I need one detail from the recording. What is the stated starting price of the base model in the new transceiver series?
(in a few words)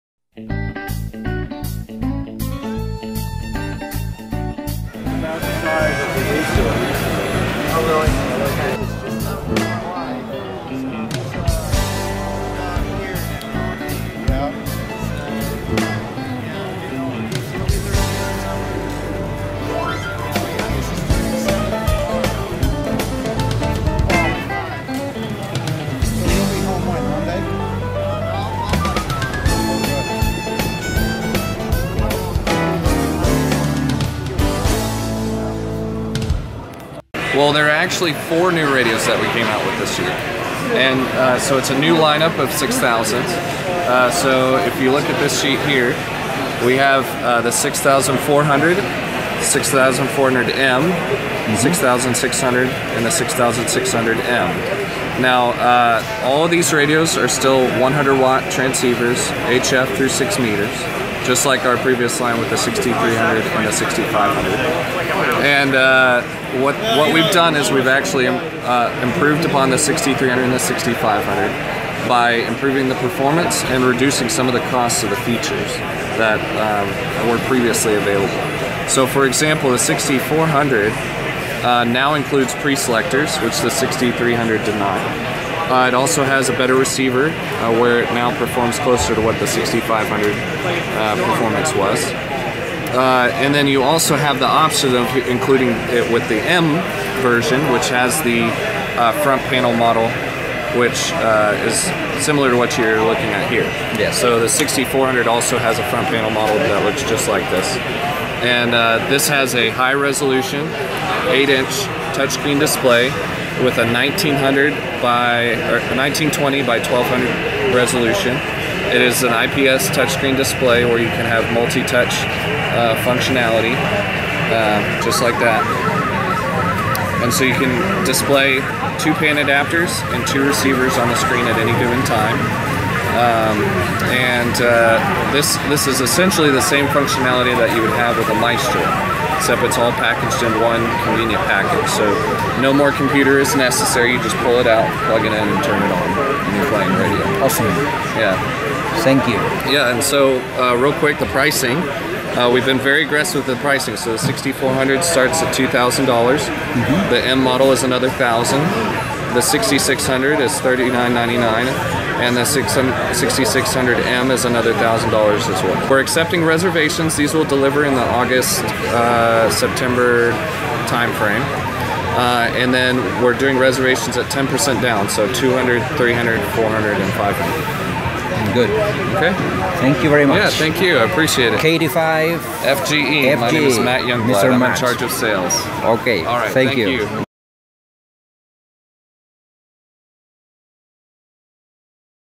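$2,000.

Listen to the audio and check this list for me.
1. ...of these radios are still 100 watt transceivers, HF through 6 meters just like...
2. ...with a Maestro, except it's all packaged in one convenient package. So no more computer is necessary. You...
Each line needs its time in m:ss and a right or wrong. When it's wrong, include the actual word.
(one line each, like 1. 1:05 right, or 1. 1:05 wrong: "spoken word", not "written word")
1. 0:56 right
2. 2:18 right.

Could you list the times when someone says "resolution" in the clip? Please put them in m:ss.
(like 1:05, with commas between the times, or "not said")
1:49, 1:57.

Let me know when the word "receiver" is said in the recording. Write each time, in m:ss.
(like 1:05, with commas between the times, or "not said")
1:26, 2:10.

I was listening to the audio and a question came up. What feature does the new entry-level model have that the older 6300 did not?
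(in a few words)
pre-selectors.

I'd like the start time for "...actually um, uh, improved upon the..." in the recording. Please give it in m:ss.
1:07.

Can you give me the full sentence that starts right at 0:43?
Uh, so if you look at this sheet here, we have uh, the 6400, 6400M, 6600, mm-hmm.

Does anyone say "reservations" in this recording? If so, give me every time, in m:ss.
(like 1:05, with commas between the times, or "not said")
2:46, 2:53.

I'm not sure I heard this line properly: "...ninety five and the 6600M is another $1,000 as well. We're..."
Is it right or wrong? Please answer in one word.
wrong.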